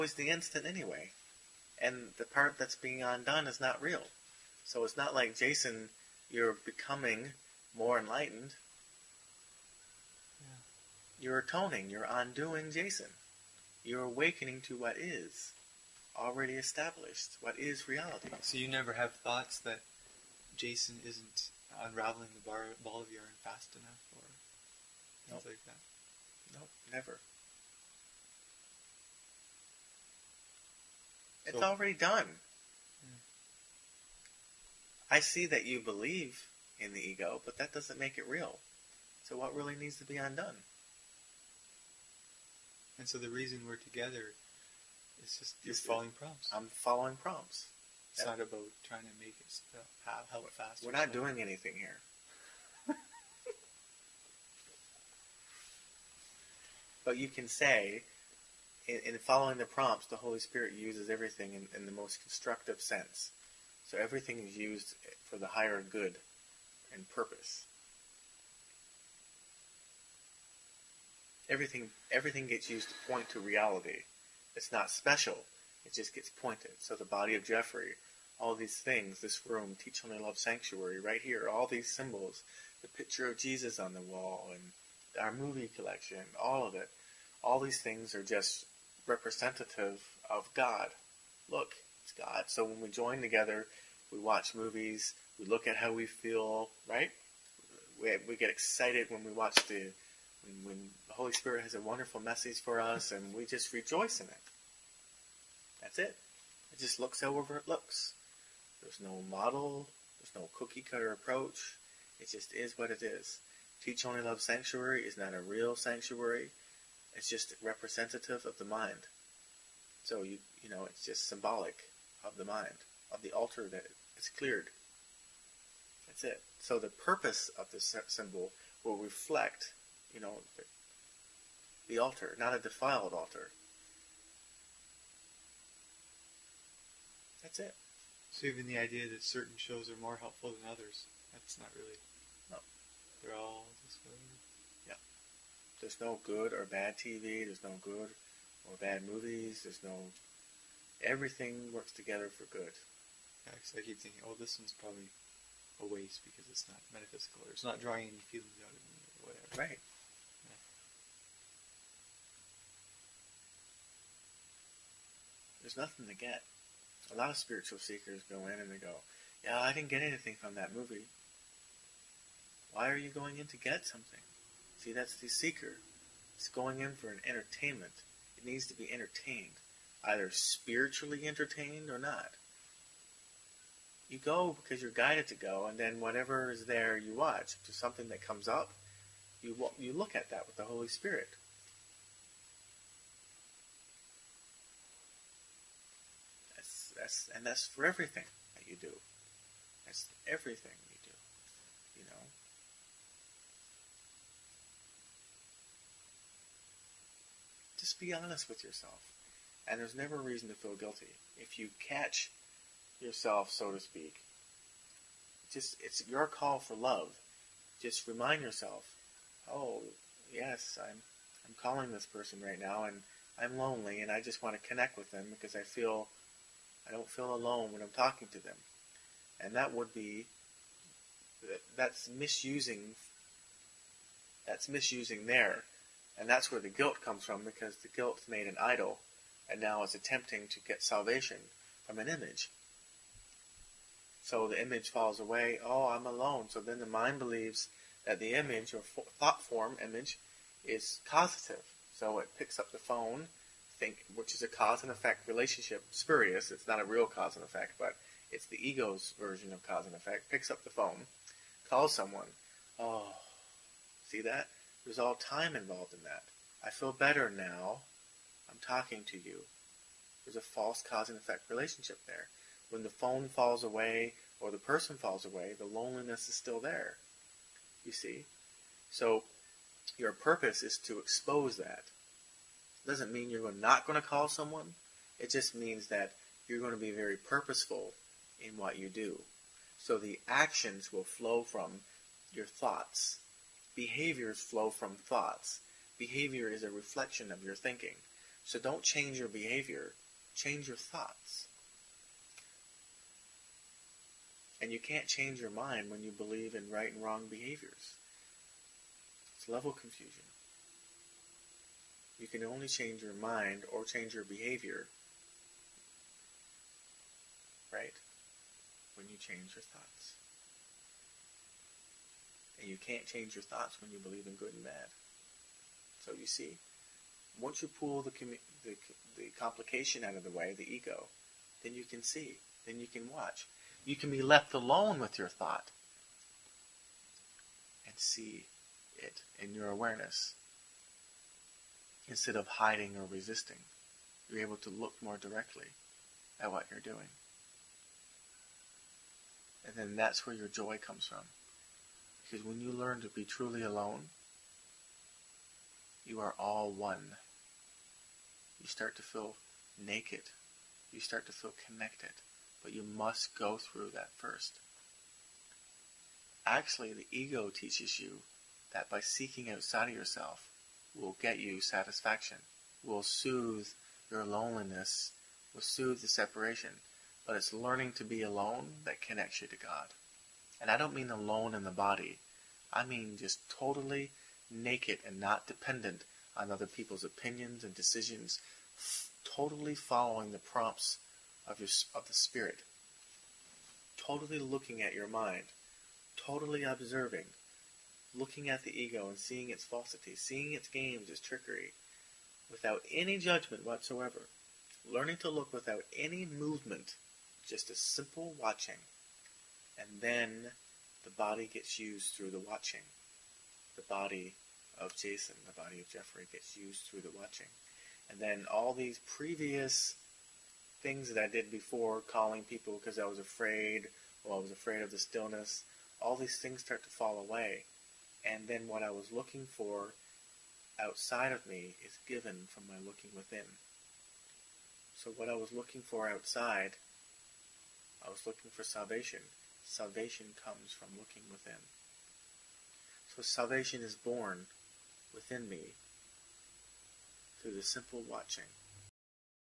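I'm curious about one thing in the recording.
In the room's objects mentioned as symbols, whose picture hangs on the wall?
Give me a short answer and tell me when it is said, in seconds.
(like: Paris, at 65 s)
Jesus, at 83 s.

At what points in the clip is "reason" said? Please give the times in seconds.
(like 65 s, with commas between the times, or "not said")
43 s, 210 s.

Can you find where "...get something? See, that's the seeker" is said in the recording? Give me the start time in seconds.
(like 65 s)
173 s.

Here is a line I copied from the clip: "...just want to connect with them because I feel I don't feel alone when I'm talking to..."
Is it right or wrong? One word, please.
right.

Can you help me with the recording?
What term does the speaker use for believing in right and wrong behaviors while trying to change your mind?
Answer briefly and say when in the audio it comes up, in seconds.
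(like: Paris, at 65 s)
level confusion, at 309 s.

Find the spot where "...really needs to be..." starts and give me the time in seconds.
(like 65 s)
39 s.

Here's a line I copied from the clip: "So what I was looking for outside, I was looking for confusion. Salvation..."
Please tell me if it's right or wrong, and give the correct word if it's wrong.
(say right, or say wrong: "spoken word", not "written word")
wrong: "salvation", not "confusion".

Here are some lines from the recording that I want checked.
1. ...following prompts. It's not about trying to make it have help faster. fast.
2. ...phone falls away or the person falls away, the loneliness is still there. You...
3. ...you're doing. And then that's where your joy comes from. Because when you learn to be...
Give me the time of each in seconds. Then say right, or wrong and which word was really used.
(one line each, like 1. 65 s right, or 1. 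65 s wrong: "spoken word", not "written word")
1. 46 s right
2. 272 s right
3. 346 s right.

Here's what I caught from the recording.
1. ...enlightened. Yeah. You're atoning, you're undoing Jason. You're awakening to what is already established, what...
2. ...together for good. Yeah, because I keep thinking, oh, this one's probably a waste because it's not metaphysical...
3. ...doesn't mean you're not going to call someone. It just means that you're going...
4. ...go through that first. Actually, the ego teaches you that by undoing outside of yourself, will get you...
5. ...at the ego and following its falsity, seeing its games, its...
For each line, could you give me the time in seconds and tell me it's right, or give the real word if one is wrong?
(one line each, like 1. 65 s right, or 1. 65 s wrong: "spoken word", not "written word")
1. 7 s right
2. 151 s right
3. 282 s right
4. 363 s wrong: "seeking", not "undoing"
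5. 398 s wrong: "seeing", not "following".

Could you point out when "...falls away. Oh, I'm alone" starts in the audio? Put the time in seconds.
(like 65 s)
244 s.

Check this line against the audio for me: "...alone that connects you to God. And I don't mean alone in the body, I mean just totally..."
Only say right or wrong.
right.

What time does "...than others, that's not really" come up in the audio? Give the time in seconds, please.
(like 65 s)
140 s.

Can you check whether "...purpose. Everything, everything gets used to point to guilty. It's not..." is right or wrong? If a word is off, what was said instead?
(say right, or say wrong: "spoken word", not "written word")
wrong: "reality", not "guilty".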